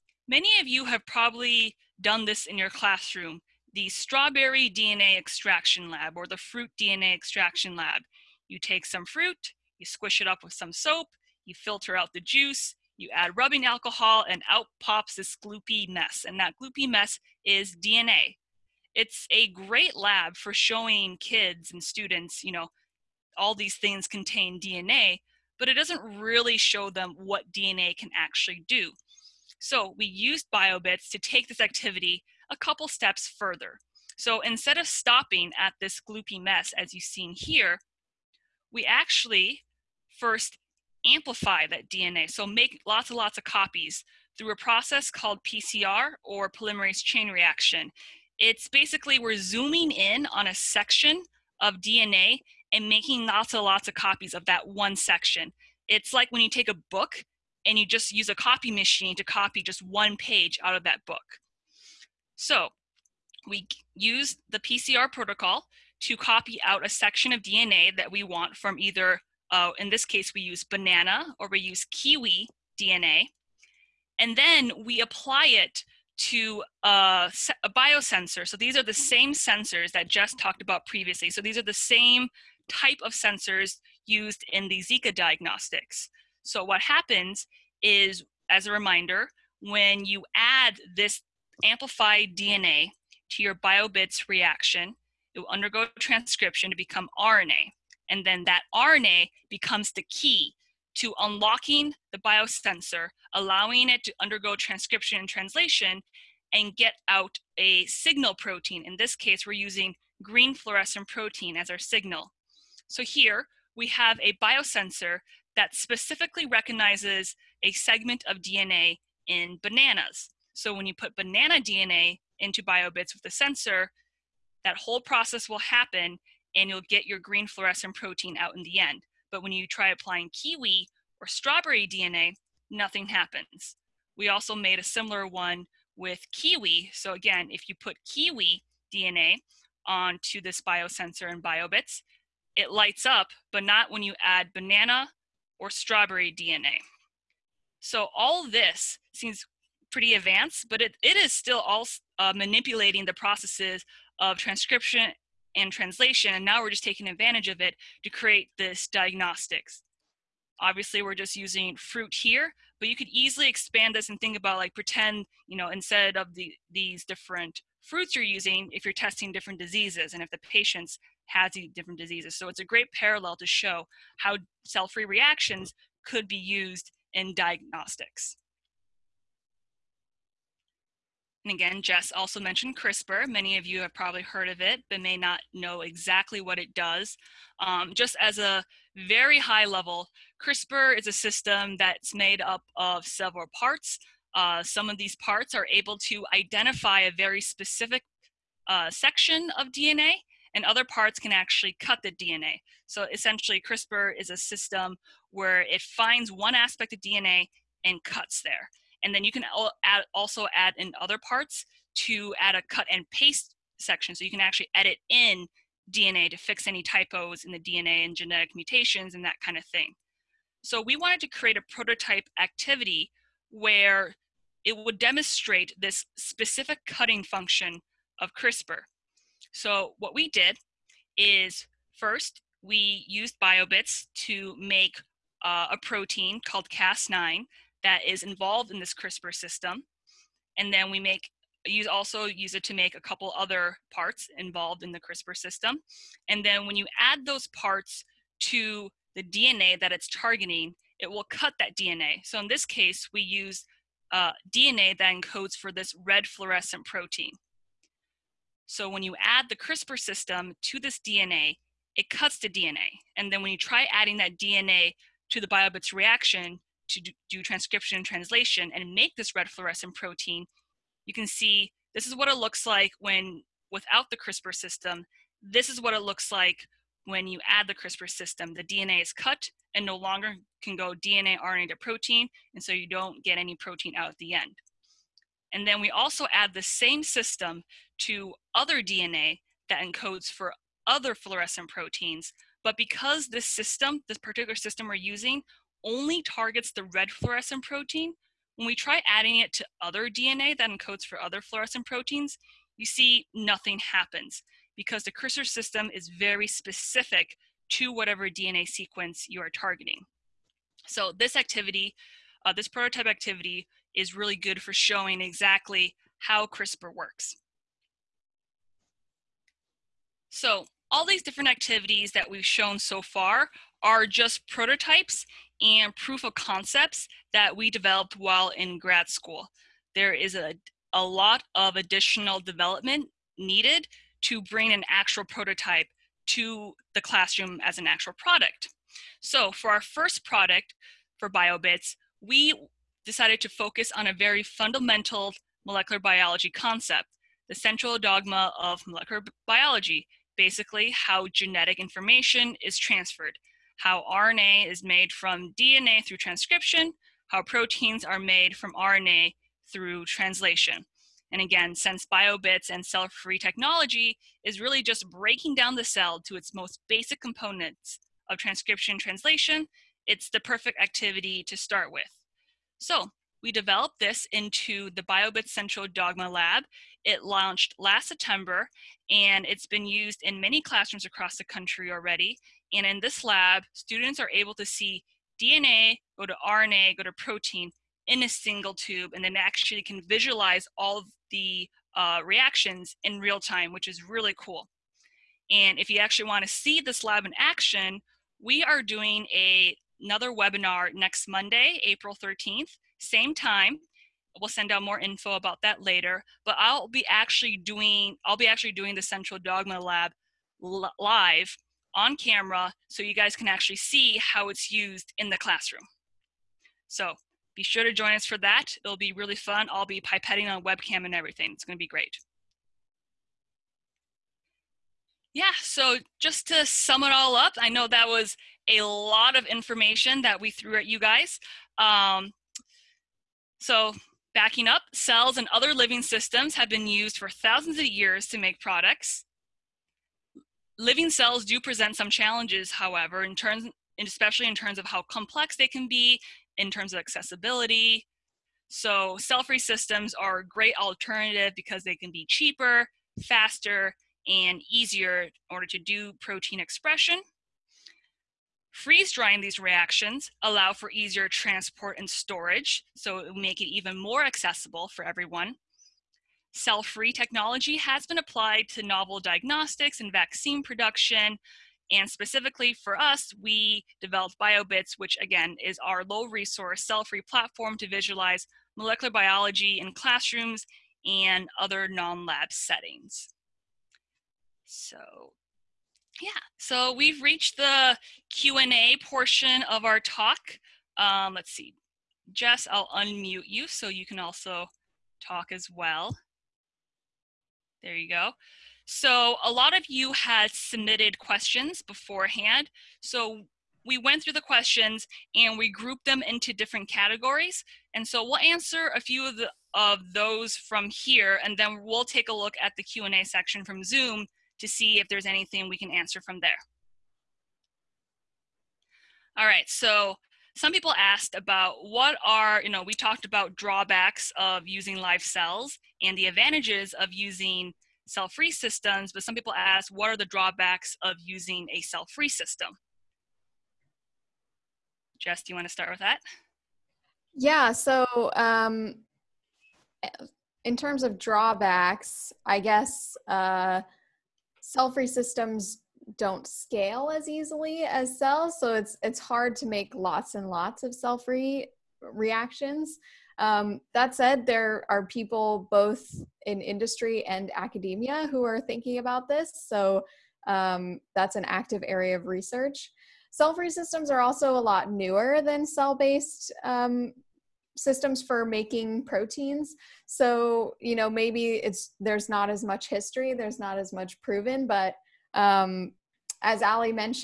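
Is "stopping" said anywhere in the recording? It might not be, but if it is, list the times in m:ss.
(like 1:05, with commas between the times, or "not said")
0:34.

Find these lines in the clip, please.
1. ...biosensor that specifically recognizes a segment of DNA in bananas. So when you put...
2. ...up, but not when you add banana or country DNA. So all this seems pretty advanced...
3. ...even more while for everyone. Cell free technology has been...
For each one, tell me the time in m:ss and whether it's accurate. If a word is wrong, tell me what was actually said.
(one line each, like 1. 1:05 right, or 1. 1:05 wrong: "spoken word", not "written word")
1. 1:54 right
2. 2:23 wrong: "strawberry", not "country"
3. 7:43 wrong: "accessible", not "while".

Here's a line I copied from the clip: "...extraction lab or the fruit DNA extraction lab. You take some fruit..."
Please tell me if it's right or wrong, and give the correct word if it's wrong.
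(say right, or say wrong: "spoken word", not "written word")
right.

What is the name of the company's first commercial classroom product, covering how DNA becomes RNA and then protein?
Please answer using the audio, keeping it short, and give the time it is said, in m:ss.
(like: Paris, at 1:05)
BioBits Central Dogma Lab, at 6:15.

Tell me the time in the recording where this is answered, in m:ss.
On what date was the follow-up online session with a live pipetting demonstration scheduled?
6:41.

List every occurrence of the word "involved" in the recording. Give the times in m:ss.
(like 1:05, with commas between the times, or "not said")
3:58, 4:04.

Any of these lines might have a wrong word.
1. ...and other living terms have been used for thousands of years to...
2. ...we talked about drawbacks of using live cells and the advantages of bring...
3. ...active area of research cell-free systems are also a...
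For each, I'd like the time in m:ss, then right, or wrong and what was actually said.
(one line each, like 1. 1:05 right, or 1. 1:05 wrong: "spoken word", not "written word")
1. 7:15 wrong: "systems", not "terms"
2. 8:42 wrong: "using", not "bring"
3. 9:21 right.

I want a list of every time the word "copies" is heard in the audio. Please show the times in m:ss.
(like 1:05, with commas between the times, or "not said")
0:43, 0:53.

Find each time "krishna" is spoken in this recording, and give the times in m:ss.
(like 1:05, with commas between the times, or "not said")
not said.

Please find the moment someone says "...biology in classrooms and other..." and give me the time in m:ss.
7:59.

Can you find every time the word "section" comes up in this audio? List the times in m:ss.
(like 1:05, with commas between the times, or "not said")
0:50, 0:54, 1:06, 3:18, 3:33, 8:33.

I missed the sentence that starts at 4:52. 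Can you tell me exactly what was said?
But because this system, this particular system we're using, only targets the red fluorescent protein.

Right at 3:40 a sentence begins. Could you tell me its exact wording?
So we wanted to create a prototype activity where it would demonstrate this specific cutting function of CRISPR.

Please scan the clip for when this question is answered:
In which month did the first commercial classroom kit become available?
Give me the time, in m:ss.
6:18.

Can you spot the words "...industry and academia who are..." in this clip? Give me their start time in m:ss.
9:16.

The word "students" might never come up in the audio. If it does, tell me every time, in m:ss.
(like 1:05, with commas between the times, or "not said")
0:21, 6:23.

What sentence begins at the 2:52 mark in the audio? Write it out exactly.
So it's a great parallel to show how cell-free reactions could be used in diagnostics.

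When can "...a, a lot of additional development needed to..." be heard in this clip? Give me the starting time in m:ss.
5:30.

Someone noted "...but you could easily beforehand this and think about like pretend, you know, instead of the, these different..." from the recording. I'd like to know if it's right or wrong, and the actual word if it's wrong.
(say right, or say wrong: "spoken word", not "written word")
wrong: "expand", not "beforehand".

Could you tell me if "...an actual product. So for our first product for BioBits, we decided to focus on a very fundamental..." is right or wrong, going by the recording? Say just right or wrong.
right.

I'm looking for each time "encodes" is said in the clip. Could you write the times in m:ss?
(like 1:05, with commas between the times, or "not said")
4:15, 4:49, 5:00.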